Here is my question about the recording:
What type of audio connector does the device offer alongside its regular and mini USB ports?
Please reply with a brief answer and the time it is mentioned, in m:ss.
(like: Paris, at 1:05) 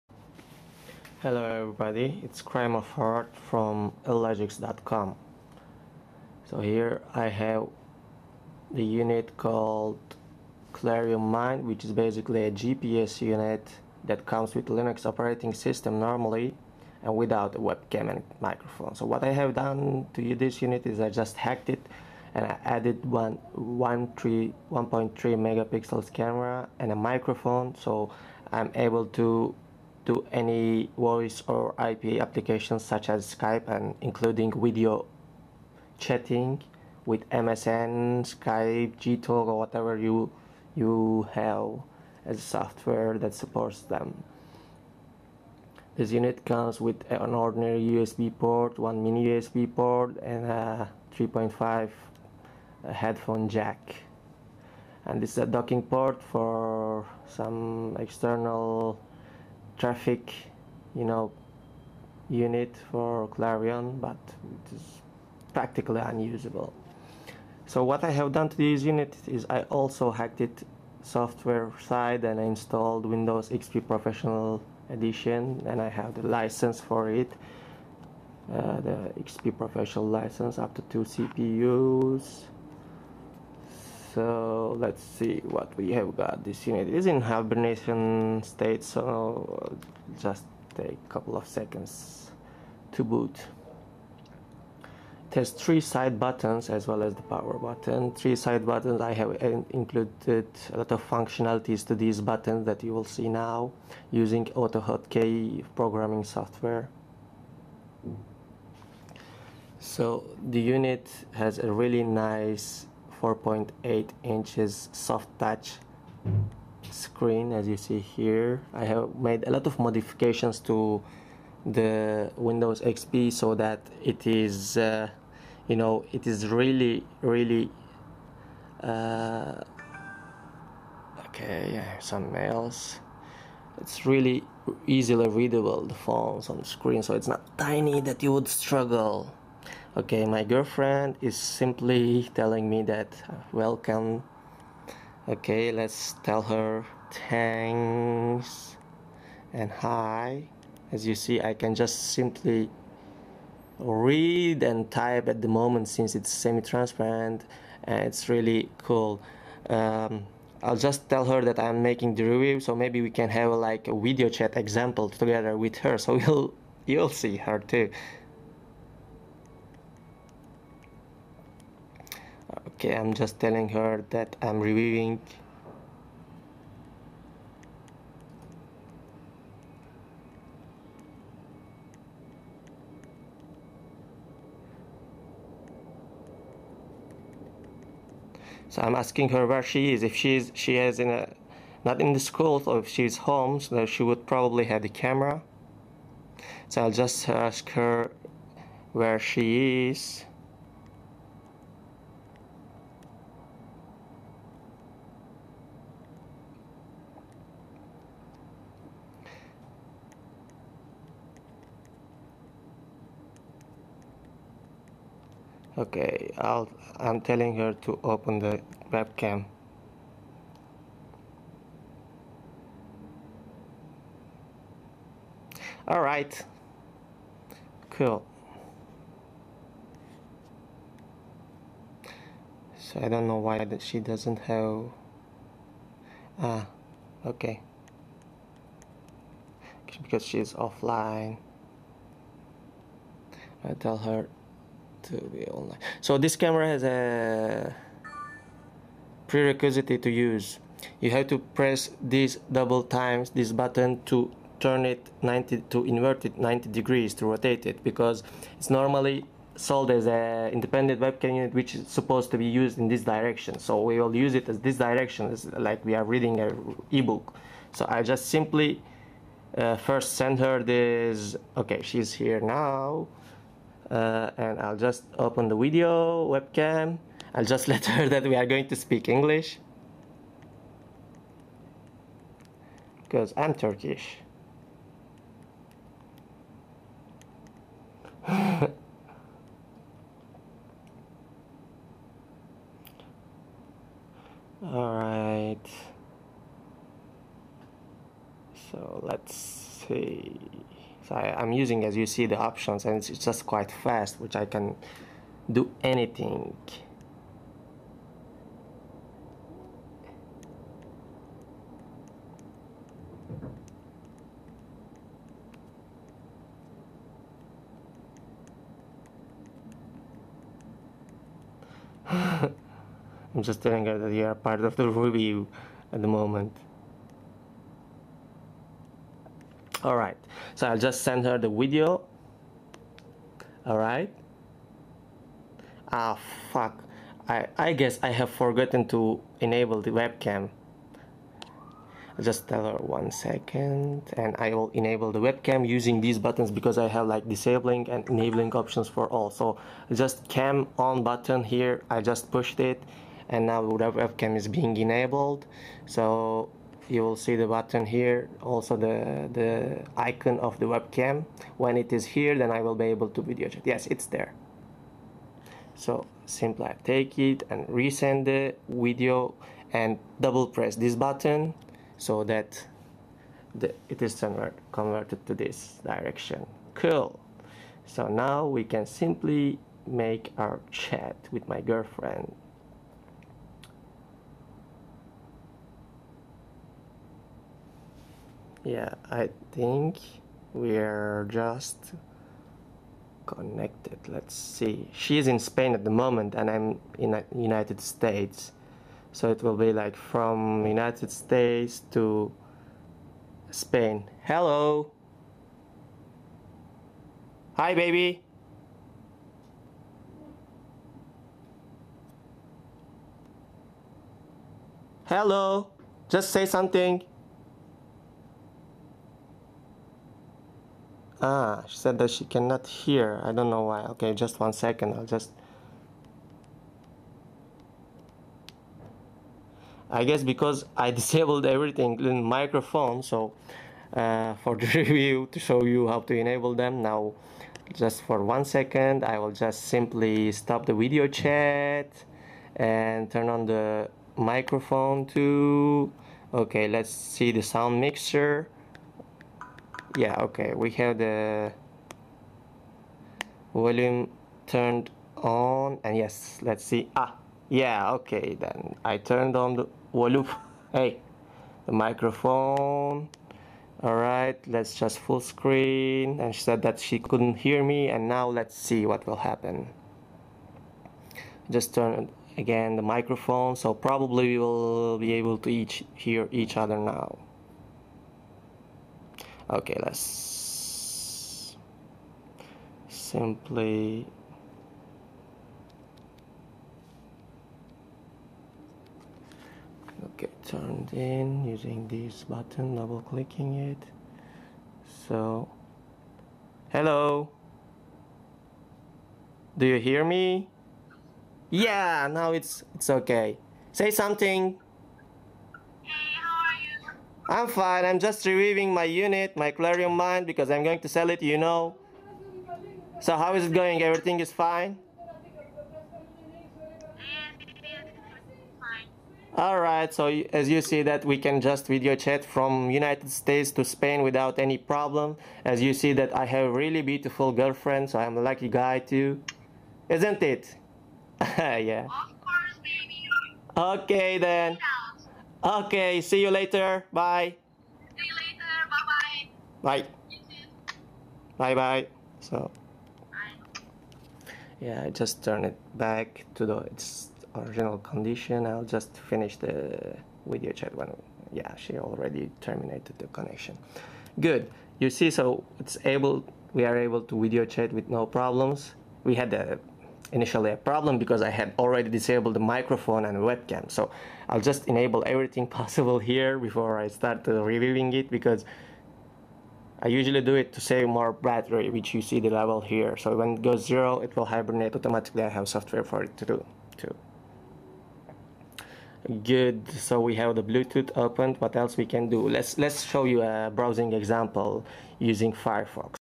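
3.5 headphone jack, at 0:51.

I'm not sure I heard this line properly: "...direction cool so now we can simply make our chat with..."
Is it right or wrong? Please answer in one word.
right.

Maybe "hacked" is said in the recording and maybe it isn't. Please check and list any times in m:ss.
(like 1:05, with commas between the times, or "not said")
0:21, 1:10.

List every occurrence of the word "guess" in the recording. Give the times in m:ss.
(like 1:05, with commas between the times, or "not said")
5:37, 7:10.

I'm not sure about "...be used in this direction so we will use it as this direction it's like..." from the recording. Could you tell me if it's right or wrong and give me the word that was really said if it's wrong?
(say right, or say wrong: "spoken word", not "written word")
right.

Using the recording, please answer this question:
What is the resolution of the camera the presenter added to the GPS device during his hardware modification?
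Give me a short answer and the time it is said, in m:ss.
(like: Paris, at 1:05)
1.3 megapixels, at 0:23.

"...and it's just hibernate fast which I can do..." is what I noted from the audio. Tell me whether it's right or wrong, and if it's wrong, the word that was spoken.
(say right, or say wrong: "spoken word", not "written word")
wrong: "quite", not "hibernate".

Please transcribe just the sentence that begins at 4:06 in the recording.
So this camera has a prerequisite to use.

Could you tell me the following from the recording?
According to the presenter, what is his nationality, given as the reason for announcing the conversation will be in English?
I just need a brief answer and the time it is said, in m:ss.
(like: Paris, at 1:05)
Turkish, at 4:43.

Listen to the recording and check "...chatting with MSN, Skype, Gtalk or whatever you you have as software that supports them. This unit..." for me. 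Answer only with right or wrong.
right.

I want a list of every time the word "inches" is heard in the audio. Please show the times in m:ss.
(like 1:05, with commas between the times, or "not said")
1:54.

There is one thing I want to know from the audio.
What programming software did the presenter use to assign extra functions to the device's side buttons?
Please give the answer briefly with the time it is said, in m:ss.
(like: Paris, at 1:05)
AutoHotKey, at 1:44.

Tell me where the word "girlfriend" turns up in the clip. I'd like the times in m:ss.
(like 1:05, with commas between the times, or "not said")
2:20, 6:21, 8:47.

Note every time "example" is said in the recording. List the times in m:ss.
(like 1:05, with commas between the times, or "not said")
2:44, 9:43.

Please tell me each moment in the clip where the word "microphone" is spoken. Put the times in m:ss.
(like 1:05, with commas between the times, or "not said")
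0:18, 0:26, 7:12, 7:24, 7:41, 7:52, 9:22.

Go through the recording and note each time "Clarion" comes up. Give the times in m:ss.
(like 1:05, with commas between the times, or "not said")
0:10, 1:03, 8:29.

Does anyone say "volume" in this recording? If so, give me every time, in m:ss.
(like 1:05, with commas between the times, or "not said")
7:33, 7:39.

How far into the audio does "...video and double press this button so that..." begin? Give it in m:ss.
6:08.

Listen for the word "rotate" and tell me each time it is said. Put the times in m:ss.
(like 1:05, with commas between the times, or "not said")
4:17.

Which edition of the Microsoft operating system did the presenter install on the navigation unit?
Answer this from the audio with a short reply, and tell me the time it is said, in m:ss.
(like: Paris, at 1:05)
Windows XP Professional Edition, at 1:13.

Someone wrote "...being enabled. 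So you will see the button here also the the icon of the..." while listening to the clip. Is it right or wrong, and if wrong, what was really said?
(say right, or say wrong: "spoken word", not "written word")
right.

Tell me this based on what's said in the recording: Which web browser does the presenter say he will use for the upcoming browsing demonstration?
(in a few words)
Firefox.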